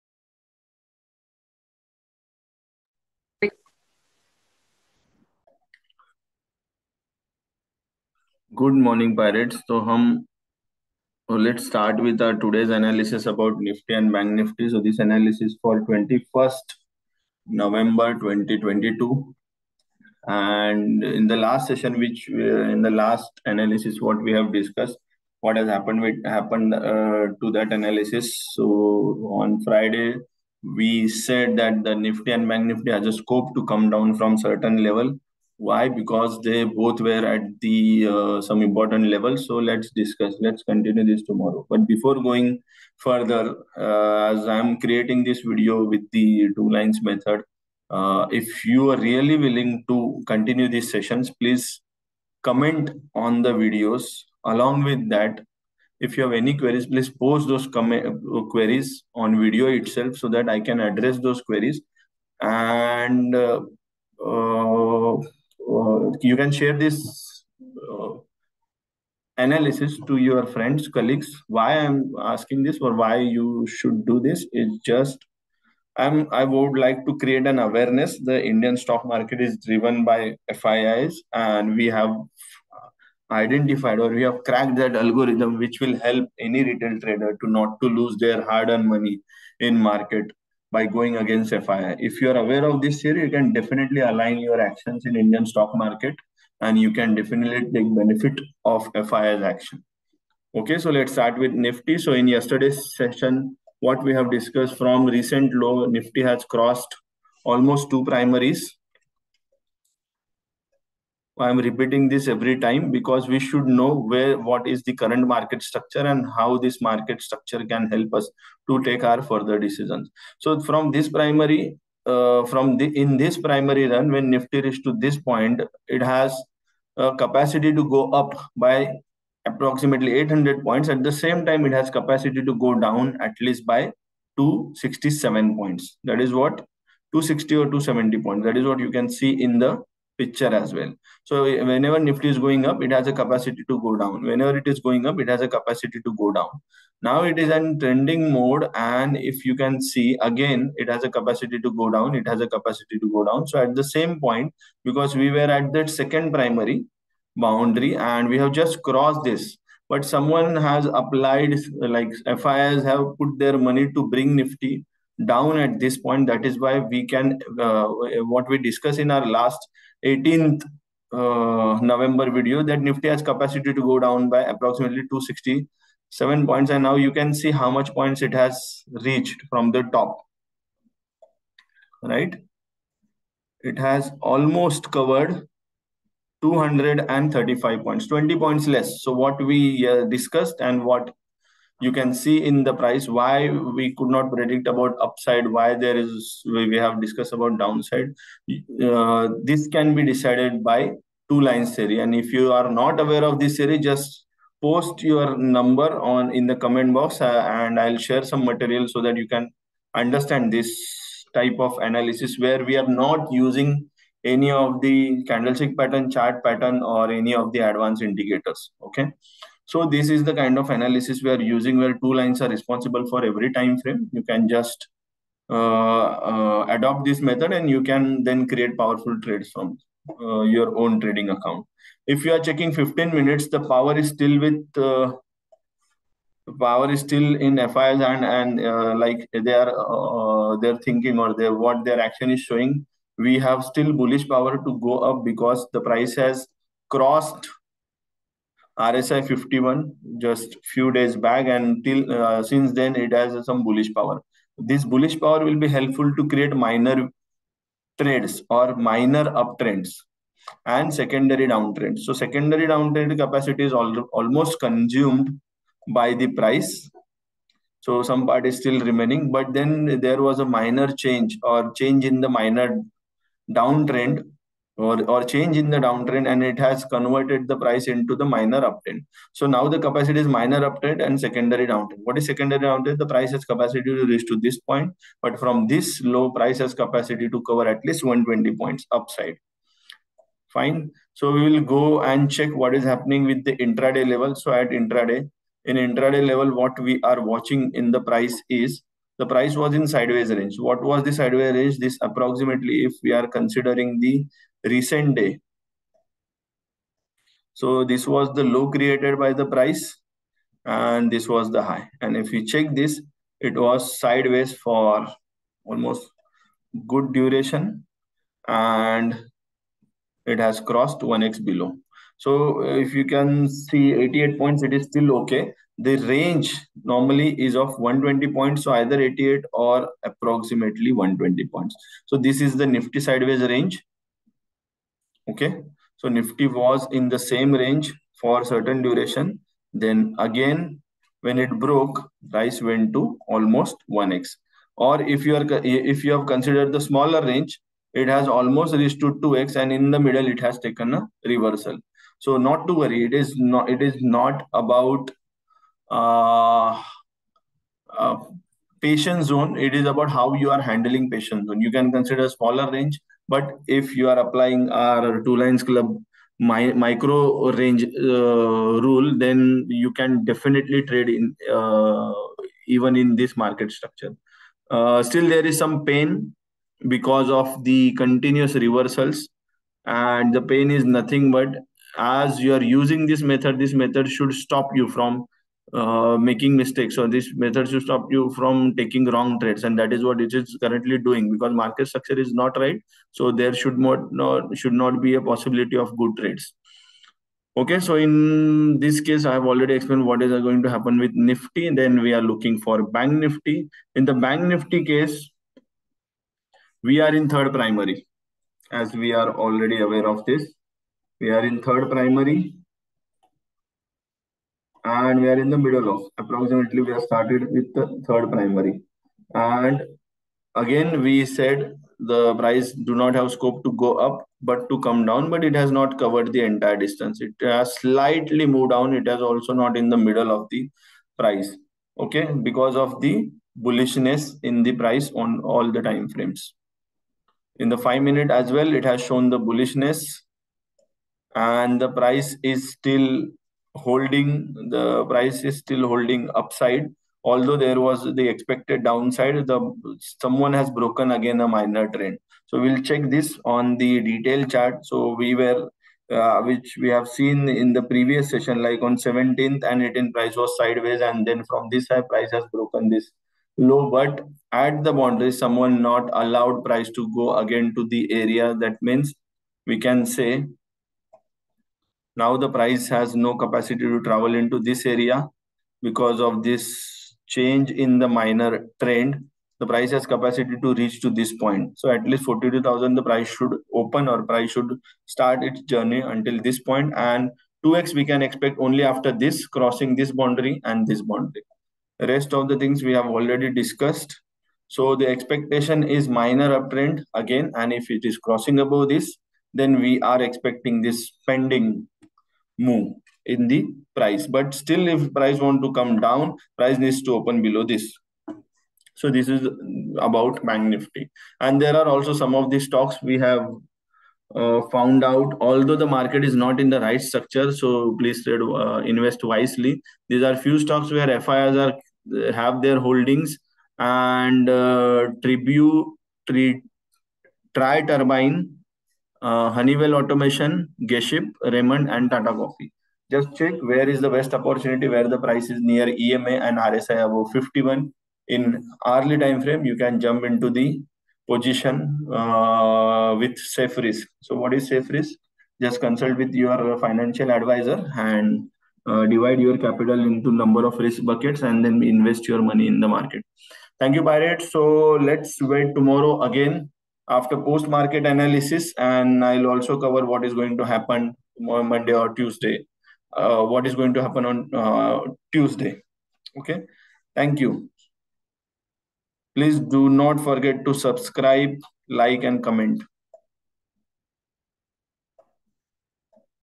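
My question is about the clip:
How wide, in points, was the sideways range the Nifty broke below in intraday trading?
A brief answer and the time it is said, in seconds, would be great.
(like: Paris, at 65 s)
88, at 323 s.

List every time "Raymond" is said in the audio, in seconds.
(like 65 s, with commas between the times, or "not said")
531 s.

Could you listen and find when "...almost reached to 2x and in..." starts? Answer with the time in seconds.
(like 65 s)
348 s.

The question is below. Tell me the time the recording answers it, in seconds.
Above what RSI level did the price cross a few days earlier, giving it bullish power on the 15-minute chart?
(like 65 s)
248 s.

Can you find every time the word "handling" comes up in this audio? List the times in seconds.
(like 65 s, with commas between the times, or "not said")
360 s.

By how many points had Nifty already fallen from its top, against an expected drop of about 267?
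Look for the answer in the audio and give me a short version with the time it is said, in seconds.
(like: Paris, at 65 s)
235, at 186 s.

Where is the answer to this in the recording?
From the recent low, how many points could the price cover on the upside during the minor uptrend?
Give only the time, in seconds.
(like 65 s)
288 s.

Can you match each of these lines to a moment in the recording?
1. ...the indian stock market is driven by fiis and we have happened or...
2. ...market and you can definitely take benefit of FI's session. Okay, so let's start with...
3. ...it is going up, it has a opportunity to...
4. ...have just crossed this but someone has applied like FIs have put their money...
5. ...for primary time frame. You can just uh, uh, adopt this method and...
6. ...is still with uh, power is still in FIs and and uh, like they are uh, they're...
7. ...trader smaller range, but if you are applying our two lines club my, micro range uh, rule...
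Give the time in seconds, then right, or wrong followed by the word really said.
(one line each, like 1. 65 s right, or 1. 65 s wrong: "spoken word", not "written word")
1. 78 s wrong: "identified", not "happened"
2. 95 s wrong: "action", not "session"
3. 144 s wrong: "capacity", not "opportunity"
4. 158 s right
5. 223 s wrong: "every", not "primary"
6. 233 s right
7. 361 s wrong: "consider", not "trader".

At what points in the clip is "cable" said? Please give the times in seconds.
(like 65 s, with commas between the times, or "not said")
not said.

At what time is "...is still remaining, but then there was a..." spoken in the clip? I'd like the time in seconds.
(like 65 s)
268 s.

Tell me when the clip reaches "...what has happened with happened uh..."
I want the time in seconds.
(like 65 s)
25 s.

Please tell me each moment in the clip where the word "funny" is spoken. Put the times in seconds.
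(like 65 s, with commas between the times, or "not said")
not said.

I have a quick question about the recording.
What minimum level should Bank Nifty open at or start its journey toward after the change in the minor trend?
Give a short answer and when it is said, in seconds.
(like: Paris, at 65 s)
42000, at 482 s.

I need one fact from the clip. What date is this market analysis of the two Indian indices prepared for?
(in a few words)
21st November 2022.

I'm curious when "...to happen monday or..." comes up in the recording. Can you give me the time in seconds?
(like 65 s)
560 s.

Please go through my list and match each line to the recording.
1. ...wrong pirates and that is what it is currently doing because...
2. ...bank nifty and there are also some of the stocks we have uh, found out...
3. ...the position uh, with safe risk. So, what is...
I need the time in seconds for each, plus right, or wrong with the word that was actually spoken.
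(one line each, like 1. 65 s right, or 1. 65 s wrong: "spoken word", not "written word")
1. 389 s wrong: "trades", not "pirates"
2. 510 s right
3. 540 s right.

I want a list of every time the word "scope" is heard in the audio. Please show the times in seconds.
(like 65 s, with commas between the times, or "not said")
33 s, 423 s.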